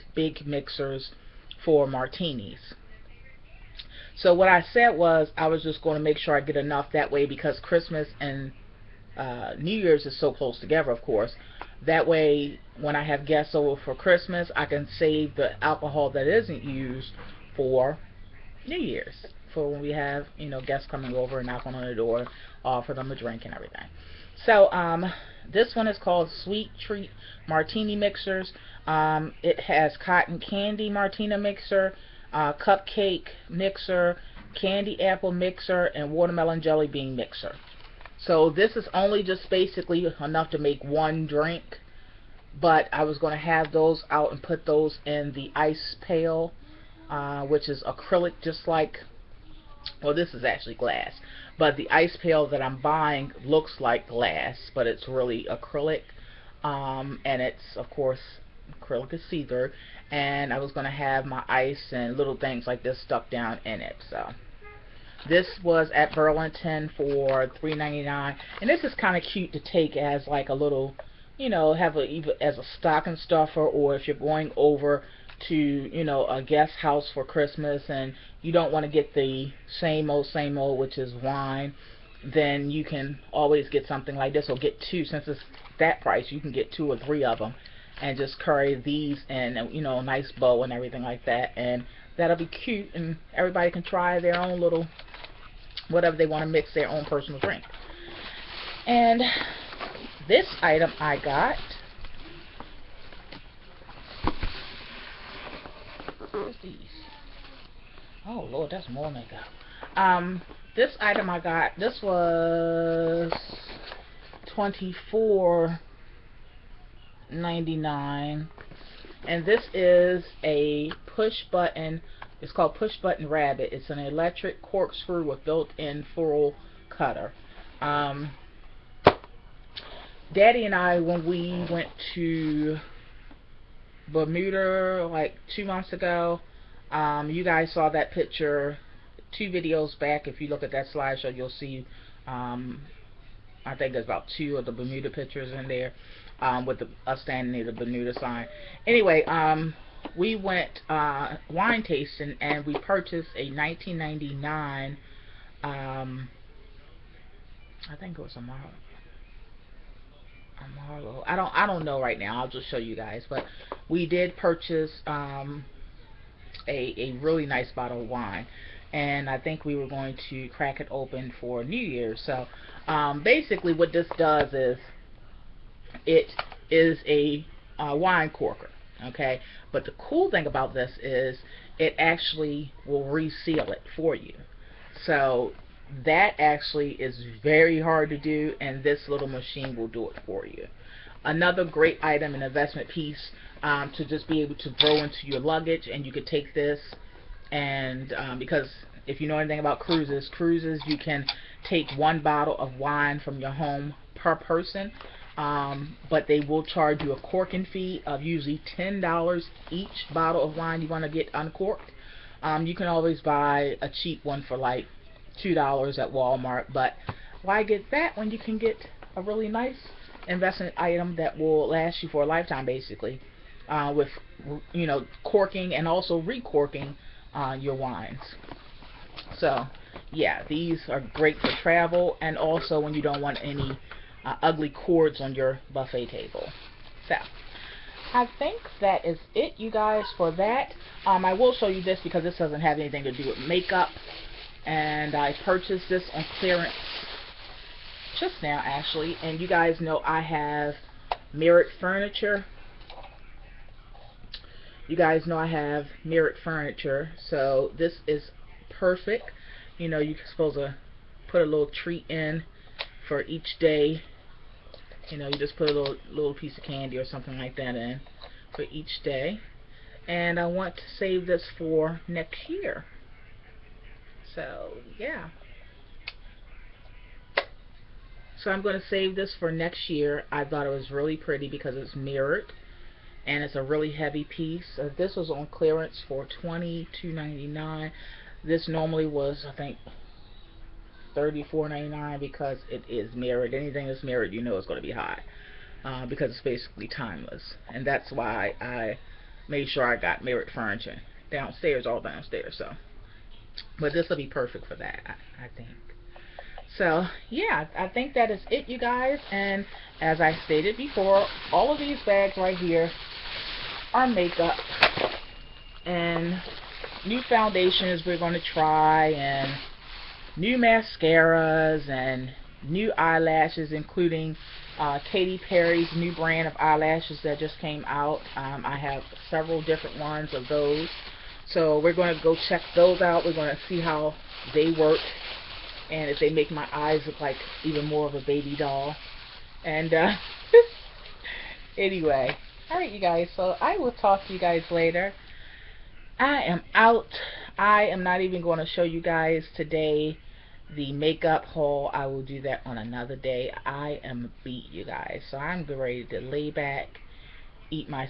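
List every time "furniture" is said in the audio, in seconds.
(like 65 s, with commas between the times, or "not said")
251 s, 256 s, 300 s.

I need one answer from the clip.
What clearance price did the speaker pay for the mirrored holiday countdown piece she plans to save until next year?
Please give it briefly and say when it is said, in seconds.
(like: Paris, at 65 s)
$22.99, at 286 s.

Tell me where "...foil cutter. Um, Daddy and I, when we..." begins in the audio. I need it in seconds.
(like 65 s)
126 s.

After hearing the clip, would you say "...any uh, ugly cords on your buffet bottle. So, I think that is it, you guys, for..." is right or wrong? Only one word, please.
wrong.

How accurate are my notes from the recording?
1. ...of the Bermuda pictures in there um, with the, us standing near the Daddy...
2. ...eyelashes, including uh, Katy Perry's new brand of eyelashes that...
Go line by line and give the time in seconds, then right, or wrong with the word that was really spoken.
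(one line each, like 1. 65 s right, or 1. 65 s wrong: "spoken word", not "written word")
1. 144 s wrong: "Bermuda", not "Daddy"
2. 322 s right.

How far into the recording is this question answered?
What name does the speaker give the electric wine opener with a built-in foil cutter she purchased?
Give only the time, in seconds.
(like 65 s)
122 s.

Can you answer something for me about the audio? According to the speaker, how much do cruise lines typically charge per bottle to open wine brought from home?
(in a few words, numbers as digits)
$10.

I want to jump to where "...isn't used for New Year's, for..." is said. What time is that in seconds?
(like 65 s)
16 s.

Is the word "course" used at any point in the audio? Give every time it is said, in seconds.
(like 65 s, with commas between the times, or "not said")
11 s, 57 s.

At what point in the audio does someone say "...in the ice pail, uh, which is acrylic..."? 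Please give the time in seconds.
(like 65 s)
45 s.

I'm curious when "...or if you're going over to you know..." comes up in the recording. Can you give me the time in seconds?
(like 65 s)
73 s.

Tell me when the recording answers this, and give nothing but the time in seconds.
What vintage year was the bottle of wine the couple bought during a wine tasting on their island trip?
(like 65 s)
153 s.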